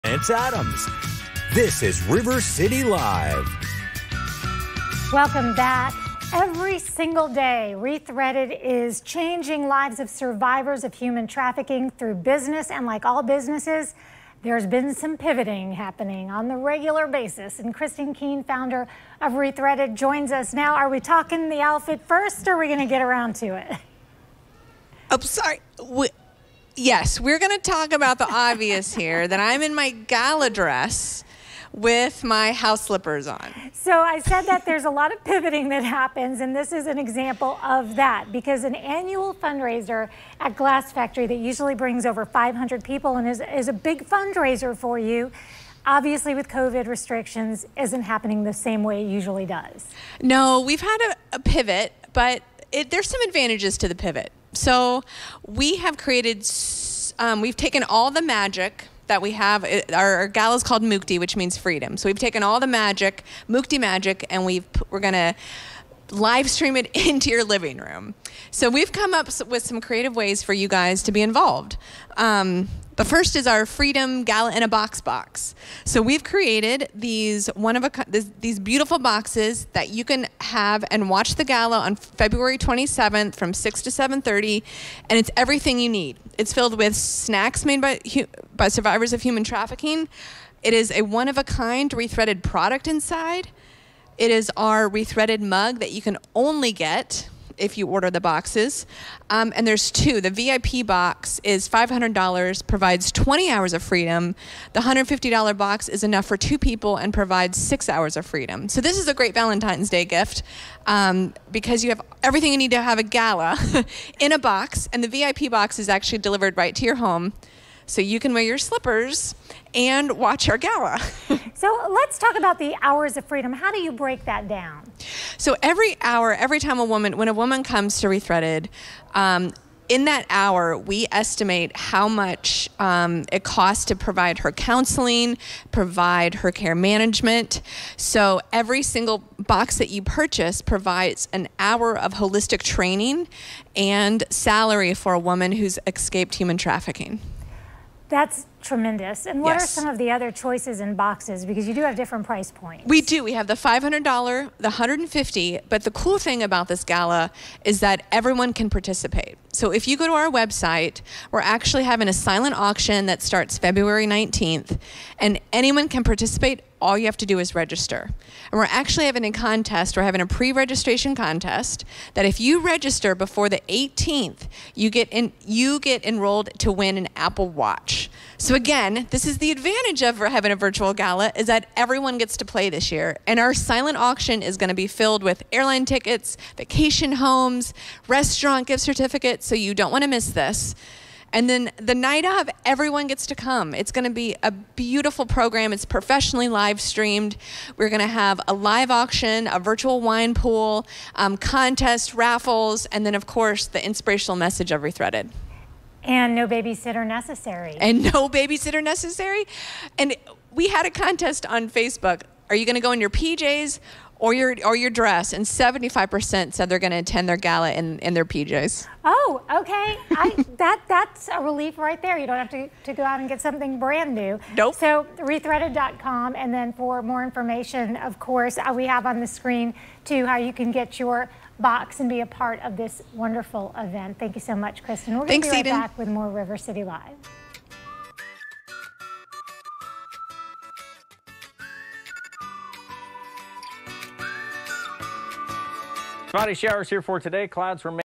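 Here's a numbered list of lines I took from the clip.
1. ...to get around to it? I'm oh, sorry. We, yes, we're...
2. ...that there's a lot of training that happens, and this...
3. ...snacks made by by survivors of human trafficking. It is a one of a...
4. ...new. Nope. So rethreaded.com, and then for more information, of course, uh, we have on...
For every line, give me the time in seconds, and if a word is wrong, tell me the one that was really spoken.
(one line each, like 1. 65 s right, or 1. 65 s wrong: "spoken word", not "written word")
1. 22 s right
2. 34 s wrong: "pivoting", not "training"
3. 86 s right
4. 224 s right.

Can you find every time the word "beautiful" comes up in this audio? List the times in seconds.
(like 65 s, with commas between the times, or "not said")
78 s, 194 s.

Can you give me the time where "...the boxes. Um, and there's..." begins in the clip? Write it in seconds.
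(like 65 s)
98 s.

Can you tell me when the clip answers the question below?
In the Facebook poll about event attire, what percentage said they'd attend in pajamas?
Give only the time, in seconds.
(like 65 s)
215 s.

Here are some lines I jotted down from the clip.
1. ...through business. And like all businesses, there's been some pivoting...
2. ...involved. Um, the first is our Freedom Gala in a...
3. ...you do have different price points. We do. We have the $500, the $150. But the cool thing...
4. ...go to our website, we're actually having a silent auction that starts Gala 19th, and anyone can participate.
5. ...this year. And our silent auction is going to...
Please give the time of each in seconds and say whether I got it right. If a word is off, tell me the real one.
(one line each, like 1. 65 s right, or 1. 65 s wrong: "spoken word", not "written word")
1. 11 s right
2. 71 s right
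3. 151 s right
4. 159 s wrong: "February", not "Gala"
5. 182 s right.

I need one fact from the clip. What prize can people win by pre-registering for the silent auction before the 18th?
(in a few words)
Apple Watch.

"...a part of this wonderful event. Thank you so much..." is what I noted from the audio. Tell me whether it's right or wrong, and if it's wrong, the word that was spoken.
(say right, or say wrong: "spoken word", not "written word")
right.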